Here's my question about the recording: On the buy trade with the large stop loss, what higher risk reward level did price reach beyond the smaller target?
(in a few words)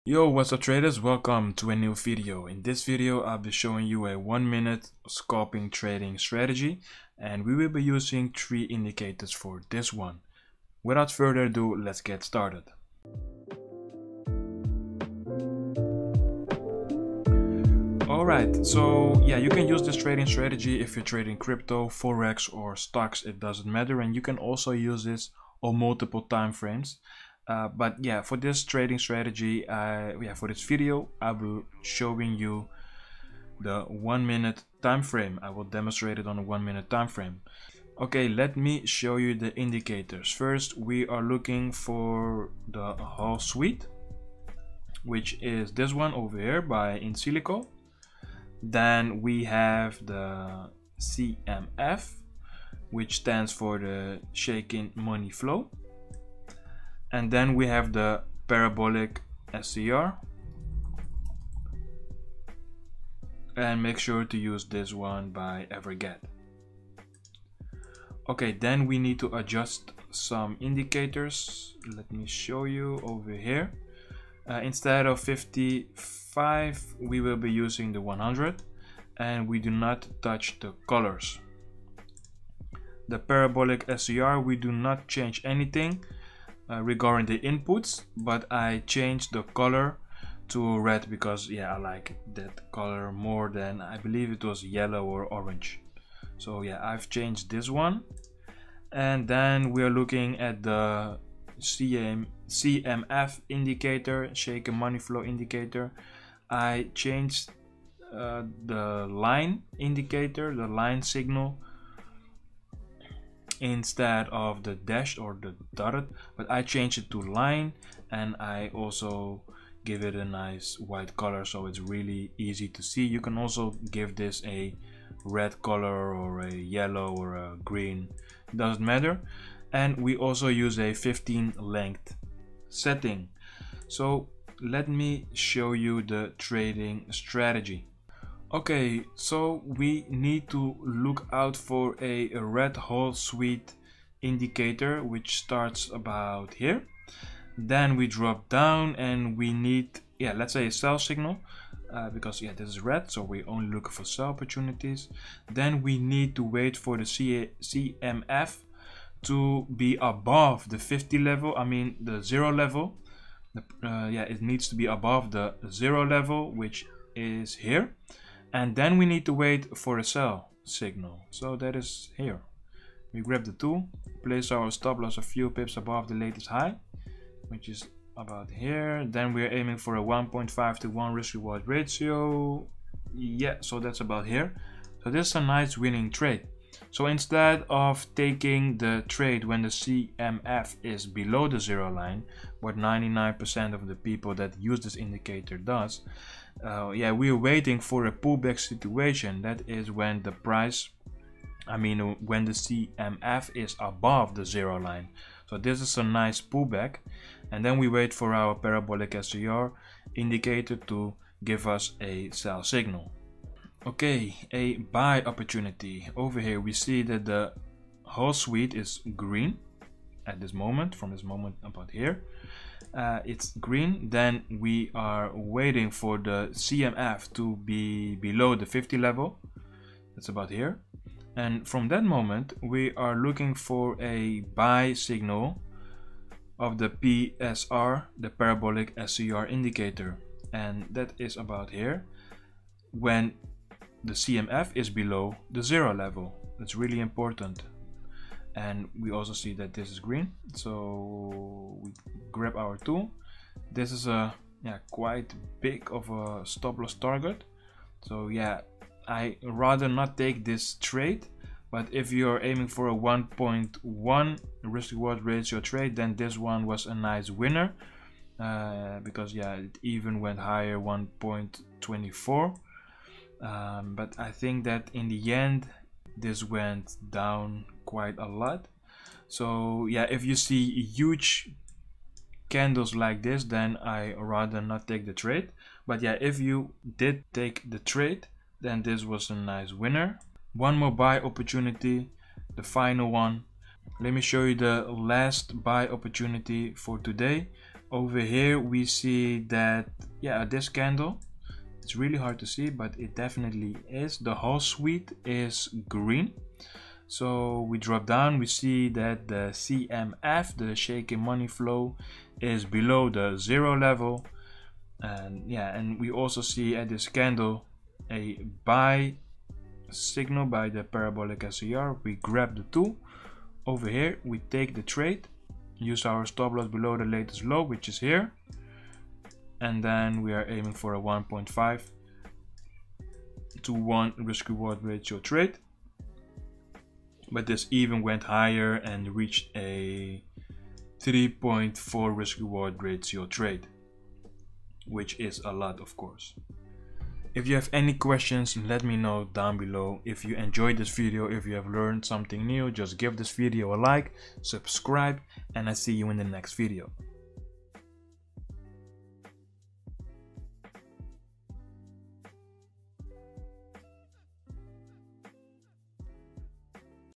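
1.24.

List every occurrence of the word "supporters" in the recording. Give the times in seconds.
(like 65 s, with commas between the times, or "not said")
not said.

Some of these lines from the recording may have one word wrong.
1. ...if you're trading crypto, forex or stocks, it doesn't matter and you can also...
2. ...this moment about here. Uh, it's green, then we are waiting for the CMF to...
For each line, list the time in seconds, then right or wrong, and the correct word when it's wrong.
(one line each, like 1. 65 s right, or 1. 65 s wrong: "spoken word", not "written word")
1. 20 s right
2. 221 s right.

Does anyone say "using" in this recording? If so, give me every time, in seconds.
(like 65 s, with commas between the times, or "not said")
7 s, 77 s.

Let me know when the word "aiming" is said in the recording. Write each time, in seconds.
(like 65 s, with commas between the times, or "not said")
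179 s, 262 s, 330 s.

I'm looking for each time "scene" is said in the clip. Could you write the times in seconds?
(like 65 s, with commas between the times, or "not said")
not said.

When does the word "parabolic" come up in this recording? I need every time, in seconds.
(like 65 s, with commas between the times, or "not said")
58 s, 83 s, 208 s, 238 s, 320 s.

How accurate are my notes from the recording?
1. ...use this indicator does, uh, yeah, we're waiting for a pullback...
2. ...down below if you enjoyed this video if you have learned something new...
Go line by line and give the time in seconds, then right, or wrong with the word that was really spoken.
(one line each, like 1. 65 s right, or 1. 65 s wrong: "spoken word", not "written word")
1. 194 s right
2. 349 s right.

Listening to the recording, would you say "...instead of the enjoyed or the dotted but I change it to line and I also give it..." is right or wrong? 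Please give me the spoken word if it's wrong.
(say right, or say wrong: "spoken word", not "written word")
wrong: "dashed", not "enjoyed".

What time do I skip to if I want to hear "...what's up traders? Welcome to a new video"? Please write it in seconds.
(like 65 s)
0 s.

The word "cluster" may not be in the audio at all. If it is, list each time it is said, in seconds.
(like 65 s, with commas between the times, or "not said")
not said.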